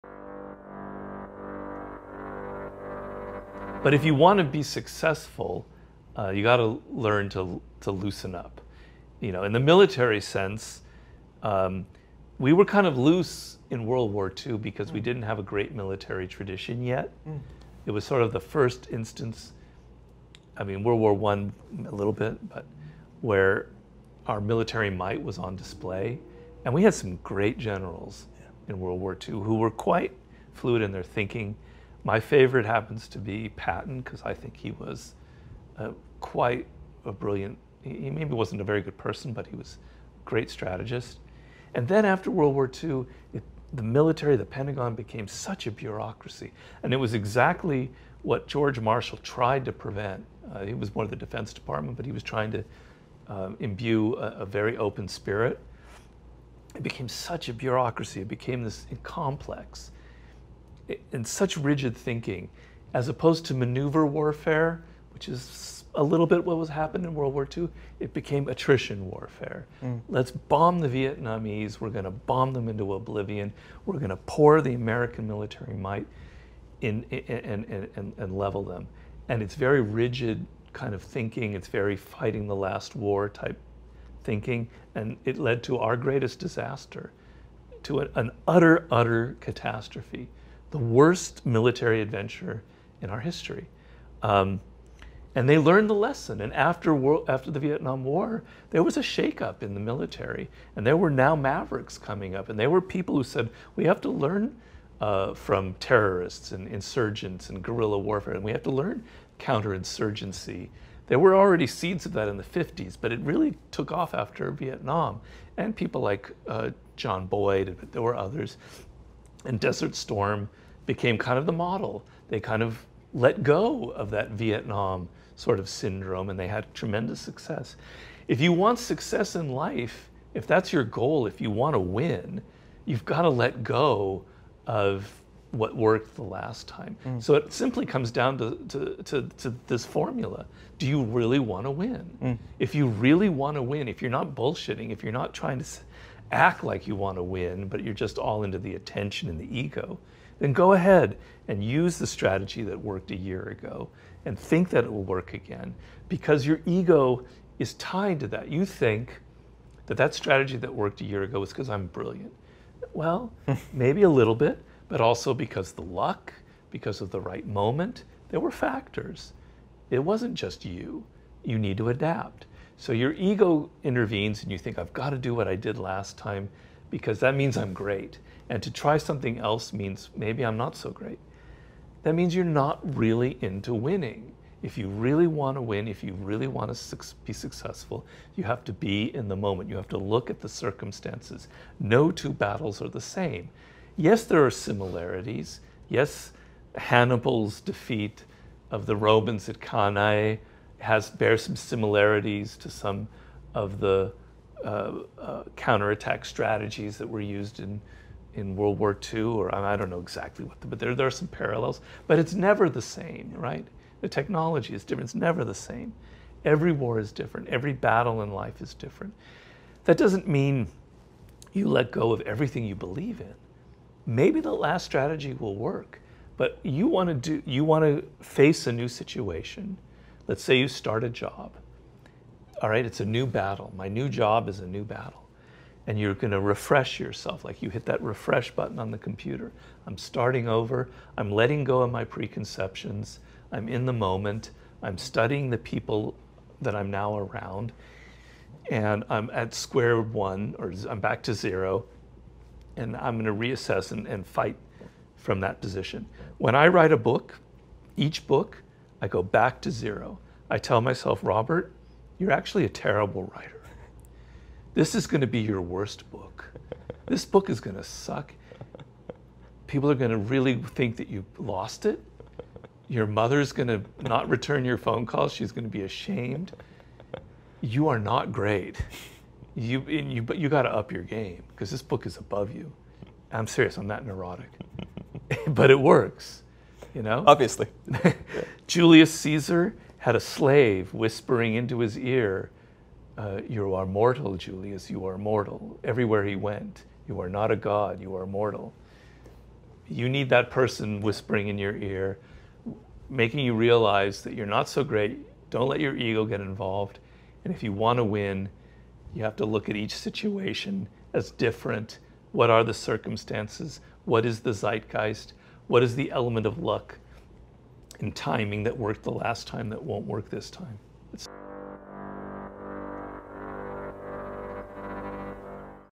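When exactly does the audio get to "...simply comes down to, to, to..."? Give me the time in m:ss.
2:17.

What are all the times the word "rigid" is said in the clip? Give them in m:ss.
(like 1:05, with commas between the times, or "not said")
1:01, 1:19.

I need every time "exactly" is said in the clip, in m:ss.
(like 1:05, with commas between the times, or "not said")
0:47, 3:29.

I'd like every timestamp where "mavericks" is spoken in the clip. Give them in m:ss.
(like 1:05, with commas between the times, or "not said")
1:41.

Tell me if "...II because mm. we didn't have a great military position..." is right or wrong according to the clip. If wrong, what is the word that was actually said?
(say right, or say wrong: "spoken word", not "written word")
wrong: "tradition", not "position".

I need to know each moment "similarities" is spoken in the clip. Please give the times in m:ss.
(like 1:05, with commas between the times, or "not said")
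3:14, 3:21.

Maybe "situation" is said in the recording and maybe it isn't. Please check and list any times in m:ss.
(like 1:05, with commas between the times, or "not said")
3:48, 5:09.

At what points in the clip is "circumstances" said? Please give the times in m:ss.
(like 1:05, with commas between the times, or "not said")
3:10, 5:12.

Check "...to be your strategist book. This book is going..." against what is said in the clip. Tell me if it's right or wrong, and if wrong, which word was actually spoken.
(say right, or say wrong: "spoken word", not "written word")
wrong: "worst", not "strategist".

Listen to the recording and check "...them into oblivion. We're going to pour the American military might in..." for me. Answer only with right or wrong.
right.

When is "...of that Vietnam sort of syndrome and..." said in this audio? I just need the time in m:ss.
2:03.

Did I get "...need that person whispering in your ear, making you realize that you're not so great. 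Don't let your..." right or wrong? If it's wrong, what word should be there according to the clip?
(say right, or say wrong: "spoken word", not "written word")
right.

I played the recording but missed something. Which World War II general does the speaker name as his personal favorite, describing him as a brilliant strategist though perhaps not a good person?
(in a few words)
Patton.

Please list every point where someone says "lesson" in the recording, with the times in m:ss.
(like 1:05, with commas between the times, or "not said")
1:35.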